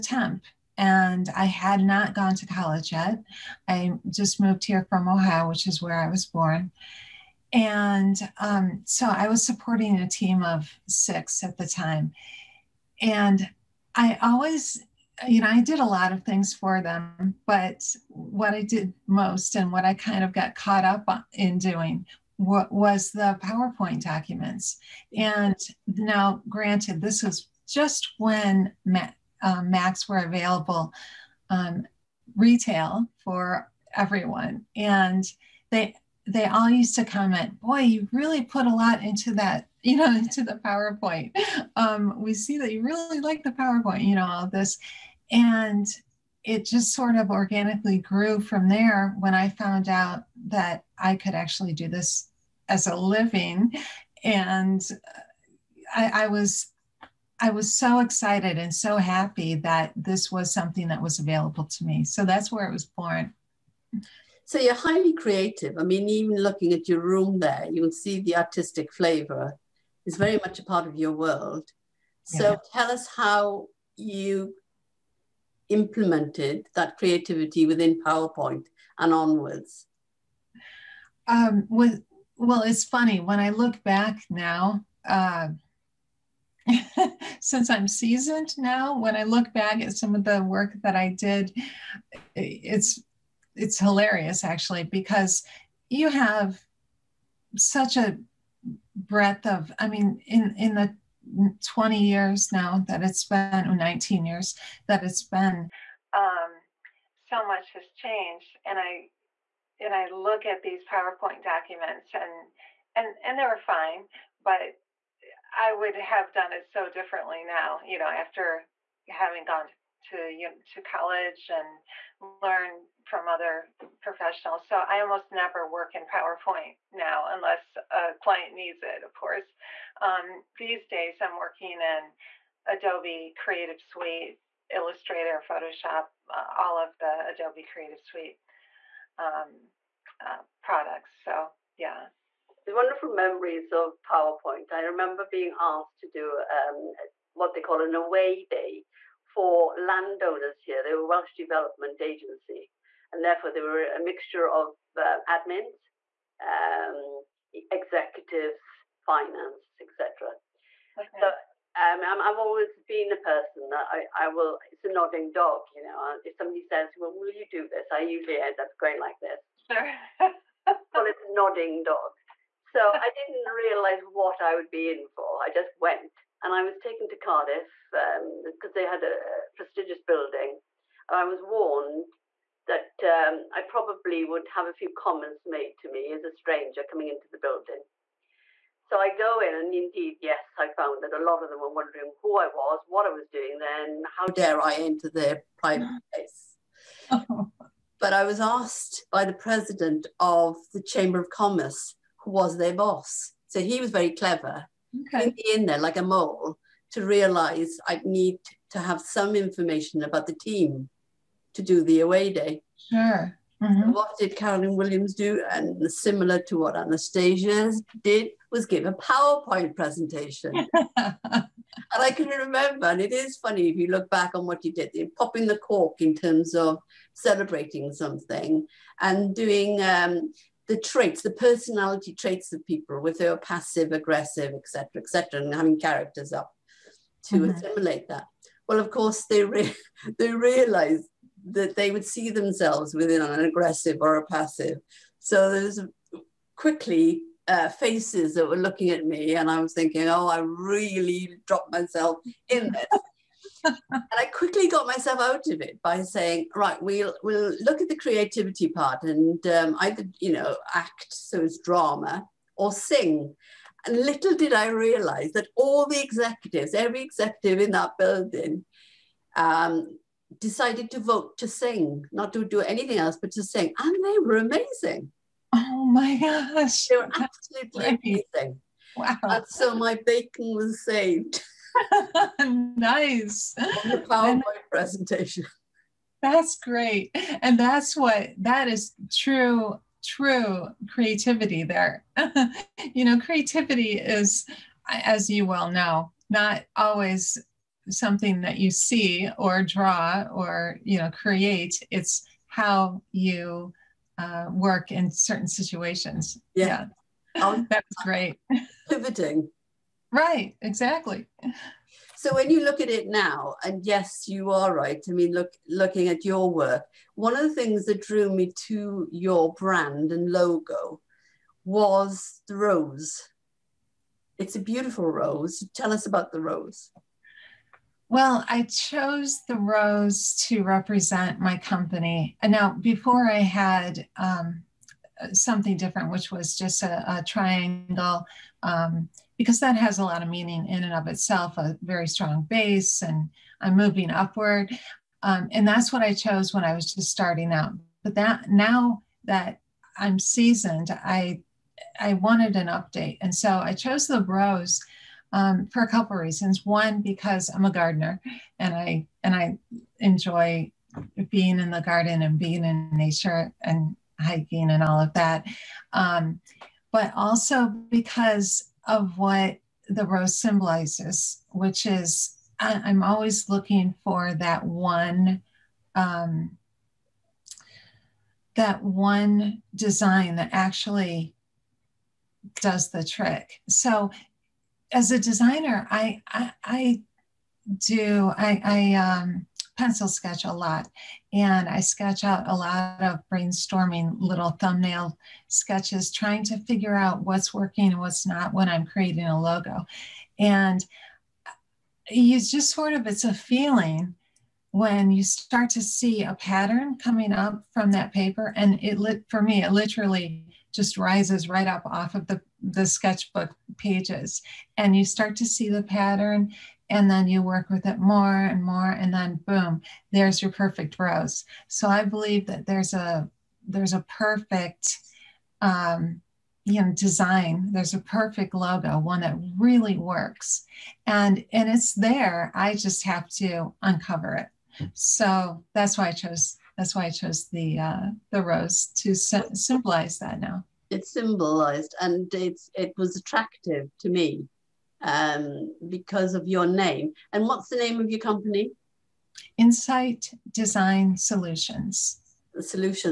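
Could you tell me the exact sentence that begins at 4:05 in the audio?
So there's quickly uh, faces that were looking at me, and I was thinking, oh, I really dropped myself in this.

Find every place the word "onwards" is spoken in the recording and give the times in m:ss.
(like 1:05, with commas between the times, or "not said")
1:19.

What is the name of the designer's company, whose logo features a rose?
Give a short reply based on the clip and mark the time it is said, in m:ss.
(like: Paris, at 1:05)
Insight Design Solutions, at 7:29.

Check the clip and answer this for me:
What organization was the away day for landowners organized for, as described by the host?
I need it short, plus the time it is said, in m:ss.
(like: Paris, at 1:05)
Welsh Development Agency, at 2:31.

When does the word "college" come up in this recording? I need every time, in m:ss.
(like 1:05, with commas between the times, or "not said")
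0:02, 2:00.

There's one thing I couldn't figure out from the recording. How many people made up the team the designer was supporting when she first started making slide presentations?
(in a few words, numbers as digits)
6.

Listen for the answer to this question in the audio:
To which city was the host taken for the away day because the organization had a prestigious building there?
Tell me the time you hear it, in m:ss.
2:57.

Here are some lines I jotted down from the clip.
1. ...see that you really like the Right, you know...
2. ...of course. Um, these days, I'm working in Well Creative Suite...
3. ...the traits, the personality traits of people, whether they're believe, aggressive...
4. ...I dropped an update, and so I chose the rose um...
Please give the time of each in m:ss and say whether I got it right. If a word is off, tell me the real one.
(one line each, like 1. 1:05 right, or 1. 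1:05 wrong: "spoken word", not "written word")
1. 0:42 wrong: "PowerPoint", not "Right"
2. 2:09 wrong: "Adobe", not "Well"
3. 3:50 wrong: "passive", not "believe"
4. 5:51 wrong: "wanted", not "dropped".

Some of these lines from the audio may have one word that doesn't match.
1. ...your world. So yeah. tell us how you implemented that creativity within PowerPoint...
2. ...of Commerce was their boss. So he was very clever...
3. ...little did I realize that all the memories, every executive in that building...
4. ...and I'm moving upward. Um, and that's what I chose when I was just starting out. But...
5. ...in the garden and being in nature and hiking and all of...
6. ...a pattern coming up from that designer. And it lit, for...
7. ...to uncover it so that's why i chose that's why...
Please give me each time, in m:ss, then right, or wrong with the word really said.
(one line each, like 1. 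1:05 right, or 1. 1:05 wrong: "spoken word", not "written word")
1. 1:10 right
2. 3:21 right
3. 4:23 wrong: "executives", not "memories"
4. 5:43 right
5. 6:01 right
6. 6:46 wrong: "paper", not "designer"
7. 7:13 right.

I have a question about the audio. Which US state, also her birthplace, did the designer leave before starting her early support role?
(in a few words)
Ohio.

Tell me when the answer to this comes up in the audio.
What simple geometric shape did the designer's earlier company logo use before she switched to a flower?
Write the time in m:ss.
5:37.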